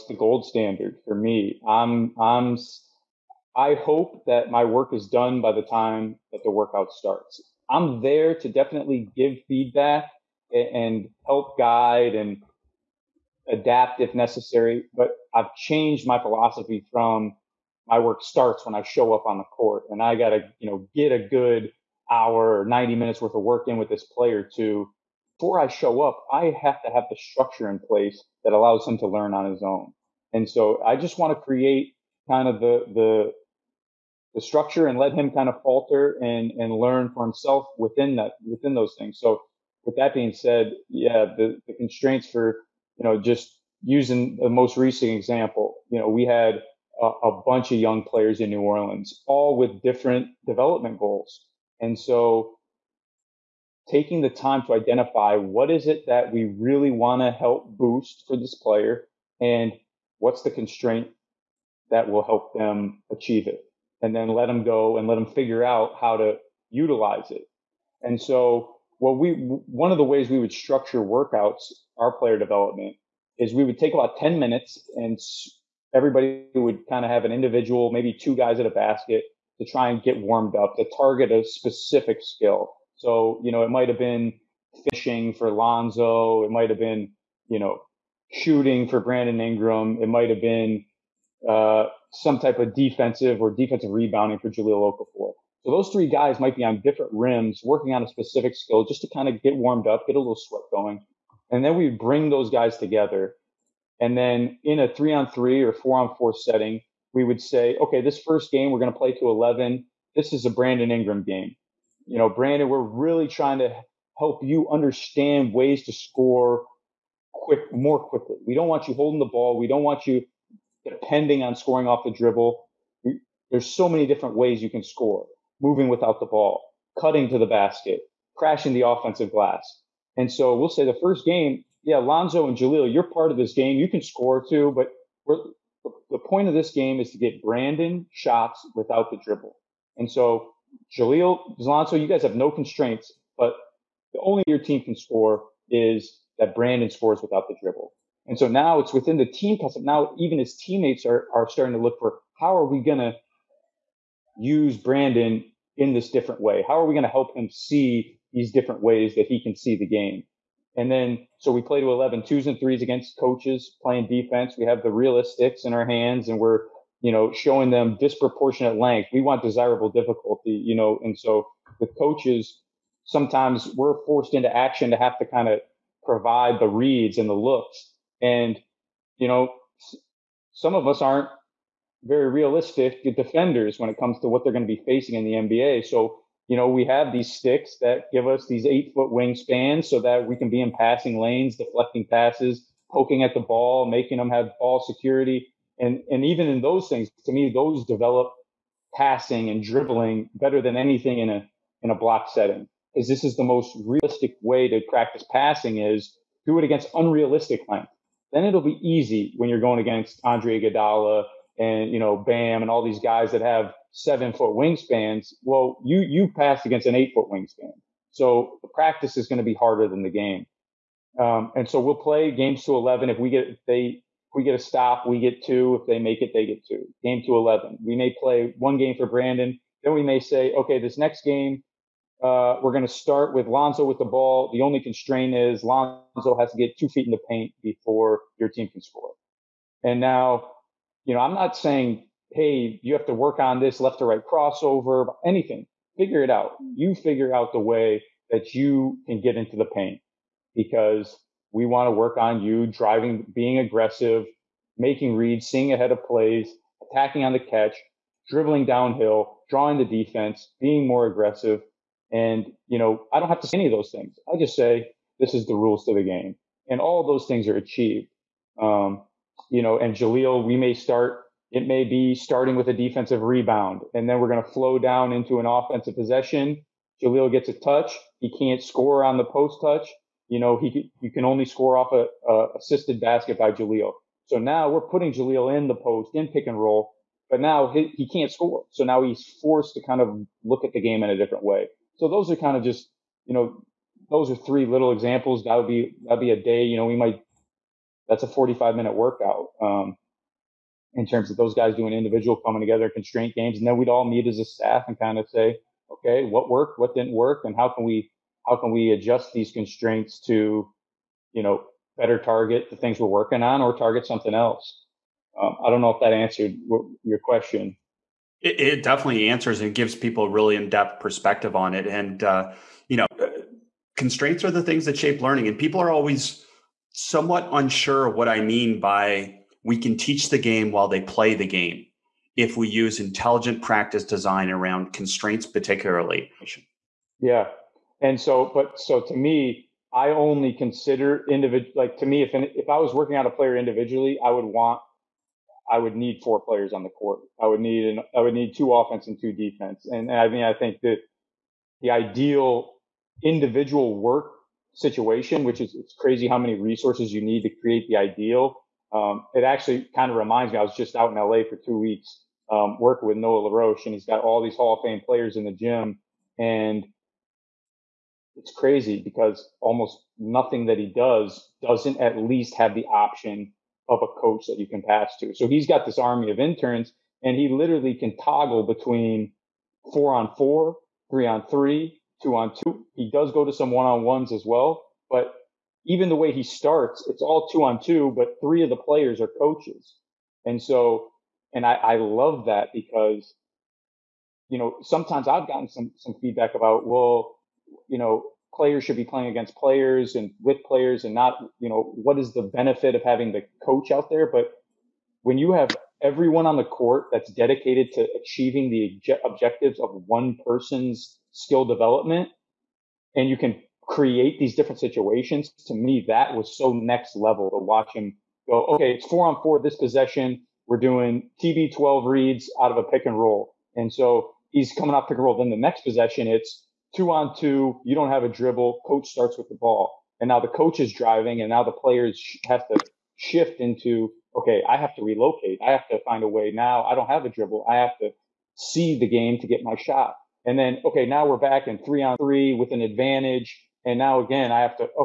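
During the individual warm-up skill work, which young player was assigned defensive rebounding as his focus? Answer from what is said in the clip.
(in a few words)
Jahlil Okafor.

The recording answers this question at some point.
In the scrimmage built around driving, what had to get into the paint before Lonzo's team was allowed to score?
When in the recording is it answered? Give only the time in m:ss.
3:56.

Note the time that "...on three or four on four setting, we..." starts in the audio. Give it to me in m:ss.
1:45.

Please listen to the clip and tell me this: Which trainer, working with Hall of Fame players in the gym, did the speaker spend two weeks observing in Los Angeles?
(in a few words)
Noah LaRoche.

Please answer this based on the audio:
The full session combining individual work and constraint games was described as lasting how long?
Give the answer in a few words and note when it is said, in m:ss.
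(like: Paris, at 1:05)
45 minutes, at 4:58.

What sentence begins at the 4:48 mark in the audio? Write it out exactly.
So now he's forced to kind of look at the game in a different way.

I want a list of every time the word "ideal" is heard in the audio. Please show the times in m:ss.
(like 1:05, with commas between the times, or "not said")
5:51, 5:57.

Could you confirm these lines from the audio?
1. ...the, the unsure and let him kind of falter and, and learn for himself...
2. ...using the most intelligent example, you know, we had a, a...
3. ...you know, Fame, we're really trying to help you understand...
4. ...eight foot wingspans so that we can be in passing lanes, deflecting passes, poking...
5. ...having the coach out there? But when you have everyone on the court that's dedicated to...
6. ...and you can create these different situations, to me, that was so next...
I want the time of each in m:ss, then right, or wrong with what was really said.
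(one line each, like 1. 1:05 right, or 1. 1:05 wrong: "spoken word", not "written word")
1. 0:32 wrong: "structure", not "unsure"
2. 0:43 wrong: "recent", not "intelligent"
3. 1:52 wrong: "Brandon", not "Fame"
4. 3:08 right
5. 6:43 right
6. 6:53 right.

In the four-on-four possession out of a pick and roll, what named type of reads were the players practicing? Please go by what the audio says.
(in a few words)
TB 12 reads.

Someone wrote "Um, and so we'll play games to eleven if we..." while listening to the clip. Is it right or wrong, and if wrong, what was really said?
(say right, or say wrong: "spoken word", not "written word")
right.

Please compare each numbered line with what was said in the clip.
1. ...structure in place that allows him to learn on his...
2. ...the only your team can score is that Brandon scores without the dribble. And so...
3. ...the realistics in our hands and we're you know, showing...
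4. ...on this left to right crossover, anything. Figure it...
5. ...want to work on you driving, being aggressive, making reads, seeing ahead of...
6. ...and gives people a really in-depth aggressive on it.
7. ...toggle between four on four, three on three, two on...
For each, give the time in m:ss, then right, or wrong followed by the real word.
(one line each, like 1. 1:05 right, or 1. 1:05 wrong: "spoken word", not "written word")
1. 0:27 right
2. 2:24 right
3. 2:44 right
4. 4:03 right
5. 4:11 right
6. 5:19 wrong: "perspective", not "aggressive"
7. 6:18 right.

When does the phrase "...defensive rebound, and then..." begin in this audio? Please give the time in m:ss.
4:32.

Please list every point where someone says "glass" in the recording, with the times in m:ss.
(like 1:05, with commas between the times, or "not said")
2:09.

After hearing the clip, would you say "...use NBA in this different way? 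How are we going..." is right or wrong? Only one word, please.
wrong.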